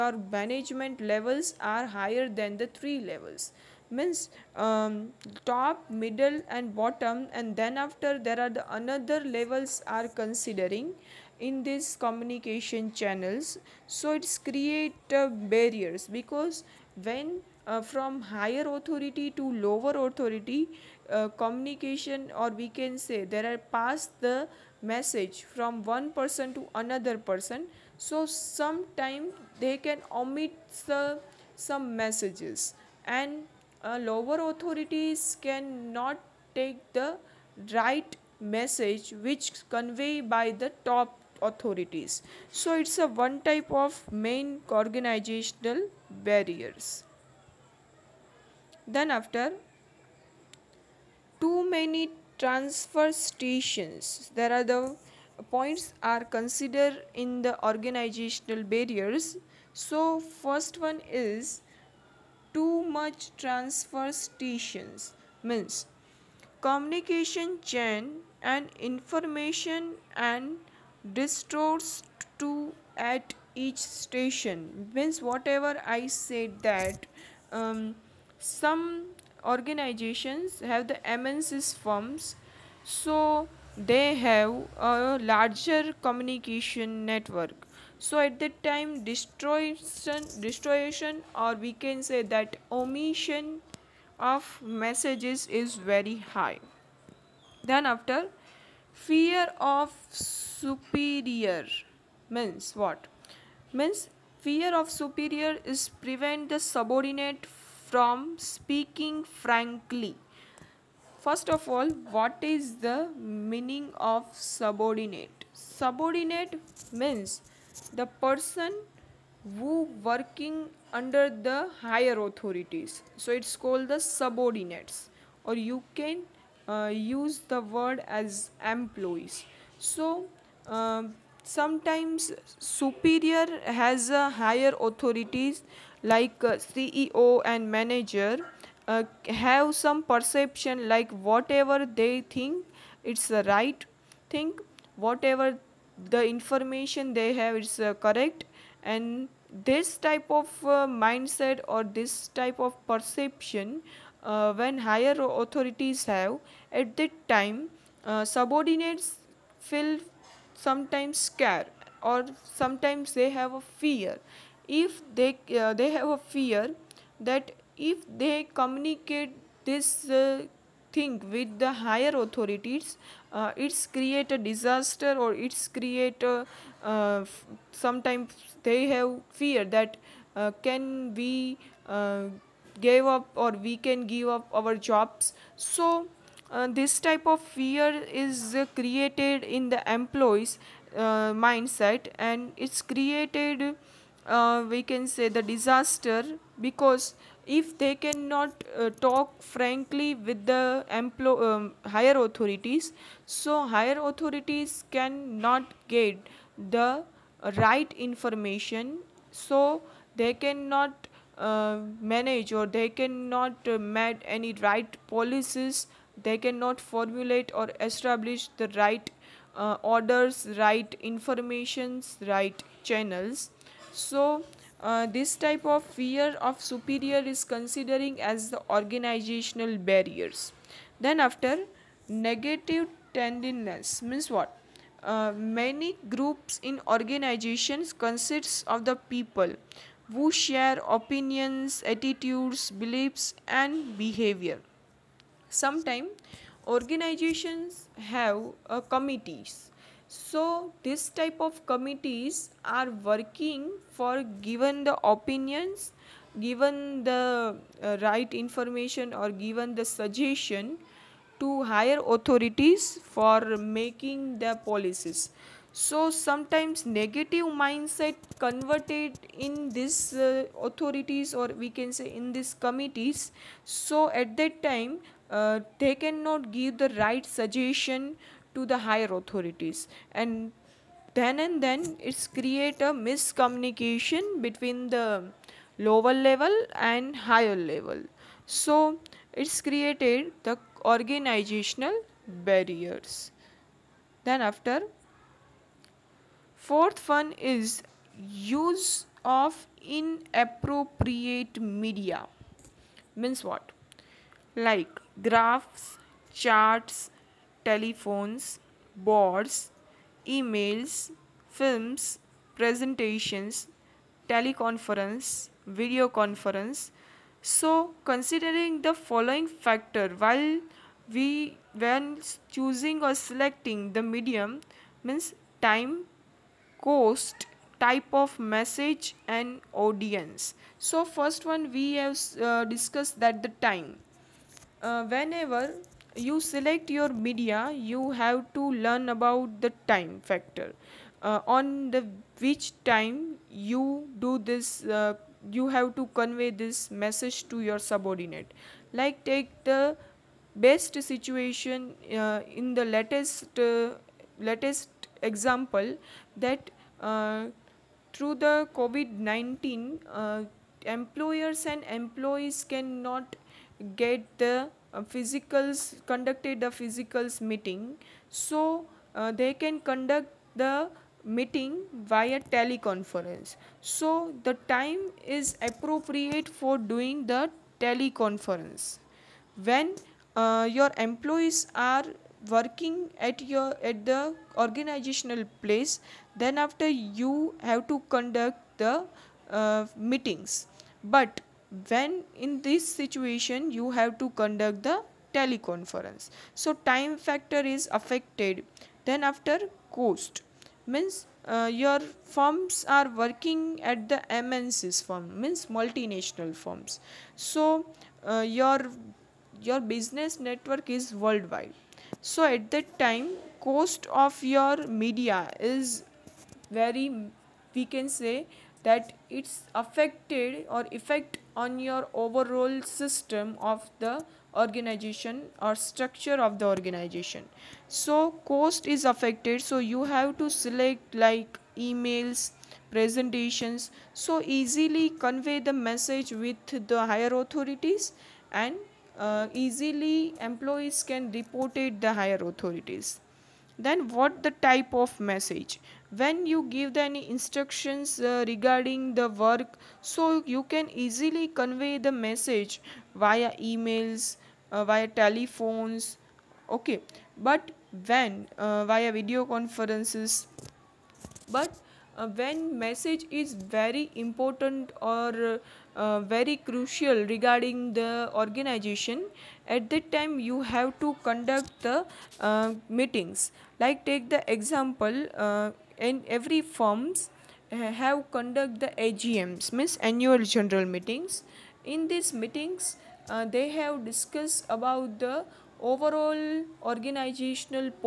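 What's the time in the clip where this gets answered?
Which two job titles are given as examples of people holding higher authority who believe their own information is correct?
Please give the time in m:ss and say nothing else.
2:16.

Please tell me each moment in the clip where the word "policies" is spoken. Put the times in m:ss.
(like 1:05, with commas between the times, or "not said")
3:35, 4:24.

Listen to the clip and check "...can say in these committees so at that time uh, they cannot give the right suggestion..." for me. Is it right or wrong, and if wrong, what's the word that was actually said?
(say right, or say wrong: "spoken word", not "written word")
right.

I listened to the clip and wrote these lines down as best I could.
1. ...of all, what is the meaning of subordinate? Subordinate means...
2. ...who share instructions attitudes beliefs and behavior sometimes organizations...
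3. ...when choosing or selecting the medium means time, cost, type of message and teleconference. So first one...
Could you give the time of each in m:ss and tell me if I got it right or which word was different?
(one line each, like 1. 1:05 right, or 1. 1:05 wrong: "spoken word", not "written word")
1. 1:51 right
2. 4:00 wrong: "opinions", not "instructions"
3. 5:21 wrong: "audience", not "teleconference".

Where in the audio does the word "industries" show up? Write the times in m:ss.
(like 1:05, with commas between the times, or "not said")
not said.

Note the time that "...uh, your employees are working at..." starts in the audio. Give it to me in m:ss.
6:20.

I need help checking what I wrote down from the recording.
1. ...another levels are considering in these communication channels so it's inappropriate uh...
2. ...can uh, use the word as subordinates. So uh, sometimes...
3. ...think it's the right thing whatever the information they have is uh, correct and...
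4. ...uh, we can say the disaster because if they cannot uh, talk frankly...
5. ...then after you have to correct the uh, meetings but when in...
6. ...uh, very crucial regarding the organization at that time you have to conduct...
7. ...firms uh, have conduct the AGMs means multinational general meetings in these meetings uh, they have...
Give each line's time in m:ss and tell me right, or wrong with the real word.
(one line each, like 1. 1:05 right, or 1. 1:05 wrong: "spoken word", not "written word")
1. 0:08 wrong: "create", not "inappropriate"
2. 2:05 wrong: "employees", not "subordinates"
3. 2:22 right
4. 3:14 right
5. 6:26 wrong: "conduct", not "correct"
6. 7:45 right
7. 7:56 wrong: "annual", not "multinational".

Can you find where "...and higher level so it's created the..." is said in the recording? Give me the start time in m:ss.
4:46.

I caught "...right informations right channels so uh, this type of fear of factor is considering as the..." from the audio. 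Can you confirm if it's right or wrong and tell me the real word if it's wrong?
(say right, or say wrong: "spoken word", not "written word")
wrong: "superior", not "factor".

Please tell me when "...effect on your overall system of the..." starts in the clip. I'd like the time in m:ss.
7:00.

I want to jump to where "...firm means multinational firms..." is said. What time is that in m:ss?
6:45.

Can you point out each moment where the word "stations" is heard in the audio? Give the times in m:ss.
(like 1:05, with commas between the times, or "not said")
0:53, 1:04, 1:13.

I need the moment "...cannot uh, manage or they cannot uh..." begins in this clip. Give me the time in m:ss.
3:30.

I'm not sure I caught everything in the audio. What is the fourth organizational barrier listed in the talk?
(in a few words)
Use of inappropriate media.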